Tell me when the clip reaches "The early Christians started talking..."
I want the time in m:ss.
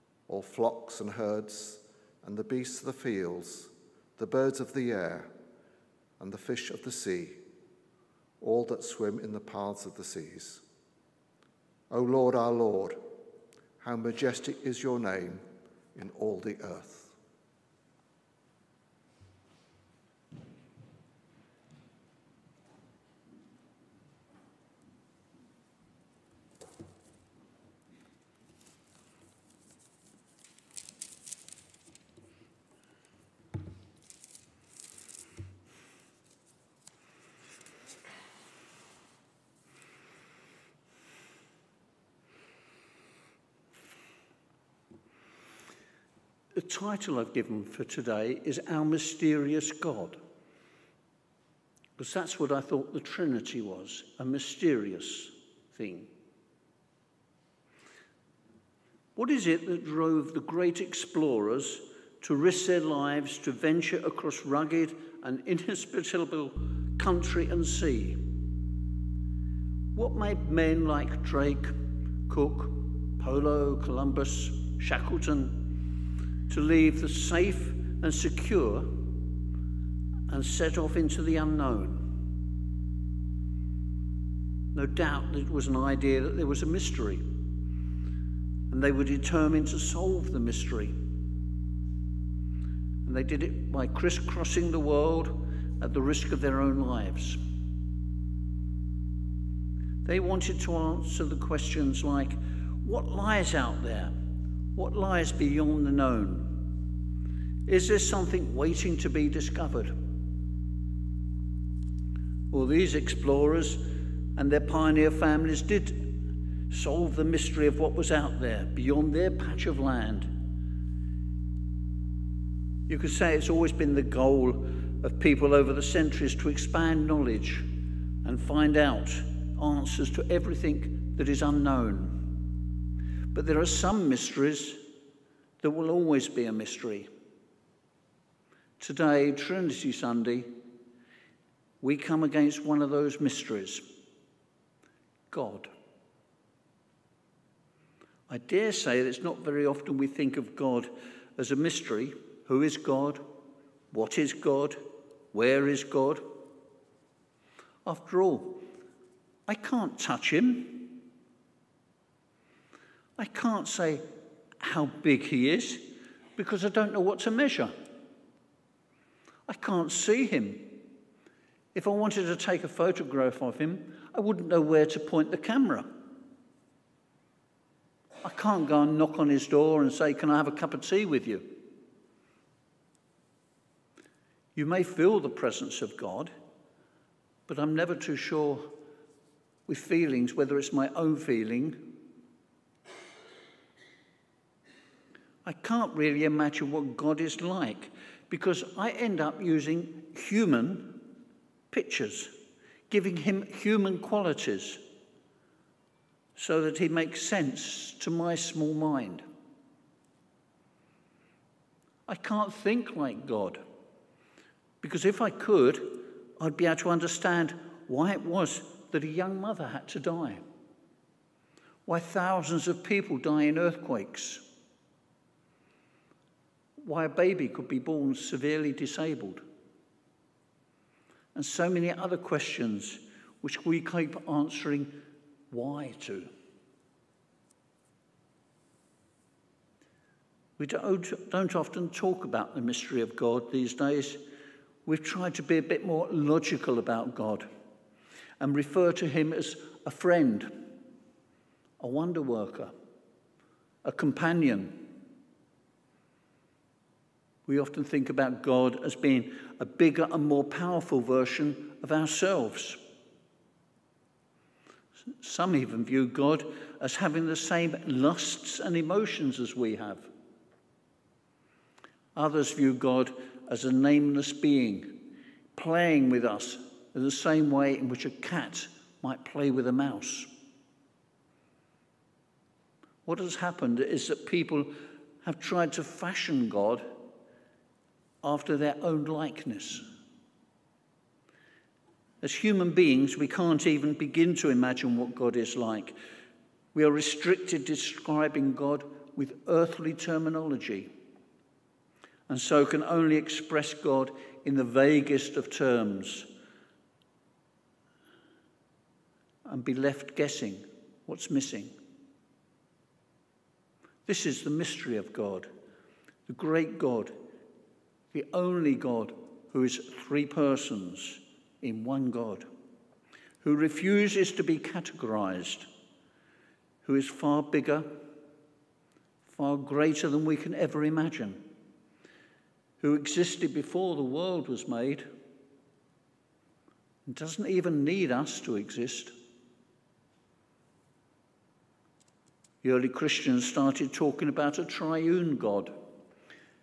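5:42.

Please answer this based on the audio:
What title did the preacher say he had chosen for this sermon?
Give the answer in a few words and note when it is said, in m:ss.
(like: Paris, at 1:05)
Our Mysterious God, at 0:48.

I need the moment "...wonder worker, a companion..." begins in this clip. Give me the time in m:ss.
4:11.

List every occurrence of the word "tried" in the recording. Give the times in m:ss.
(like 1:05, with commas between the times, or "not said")
4:05, 4:45.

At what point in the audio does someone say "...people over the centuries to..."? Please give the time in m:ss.
2:05.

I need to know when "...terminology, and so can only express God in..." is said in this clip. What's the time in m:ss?
4:59.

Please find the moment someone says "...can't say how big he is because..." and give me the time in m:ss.
2:43.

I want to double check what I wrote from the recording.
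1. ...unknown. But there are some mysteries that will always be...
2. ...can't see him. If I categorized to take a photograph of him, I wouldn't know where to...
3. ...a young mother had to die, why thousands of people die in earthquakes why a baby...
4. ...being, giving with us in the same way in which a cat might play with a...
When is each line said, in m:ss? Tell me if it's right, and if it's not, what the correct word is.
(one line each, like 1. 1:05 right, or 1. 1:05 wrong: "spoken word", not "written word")
1. 2:11 right
2. 2:49 wrong: "wanted", not "categorized"
3. 3:39 right
4. 4:34 wrong: "playing", not "giving".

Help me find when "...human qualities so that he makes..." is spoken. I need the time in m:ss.
3:23.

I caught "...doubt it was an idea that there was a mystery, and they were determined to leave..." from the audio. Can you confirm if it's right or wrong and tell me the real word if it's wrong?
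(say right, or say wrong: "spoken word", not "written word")
wrong: "solve", not "leave".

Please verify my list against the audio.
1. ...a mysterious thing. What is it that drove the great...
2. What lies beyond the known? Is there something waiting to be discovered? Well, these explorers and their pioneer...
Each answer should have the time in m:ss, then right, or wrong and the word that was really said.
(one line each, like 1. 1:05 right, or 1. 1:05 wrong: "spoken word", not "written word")
1. 0:54 right
2. 1:44 right.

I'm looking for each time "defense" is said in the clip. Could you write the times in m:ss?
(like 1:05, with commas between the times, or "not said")
not said.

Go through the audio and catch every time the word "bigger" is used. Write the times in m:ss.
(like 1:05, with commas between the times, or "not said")
4:19, 5:27.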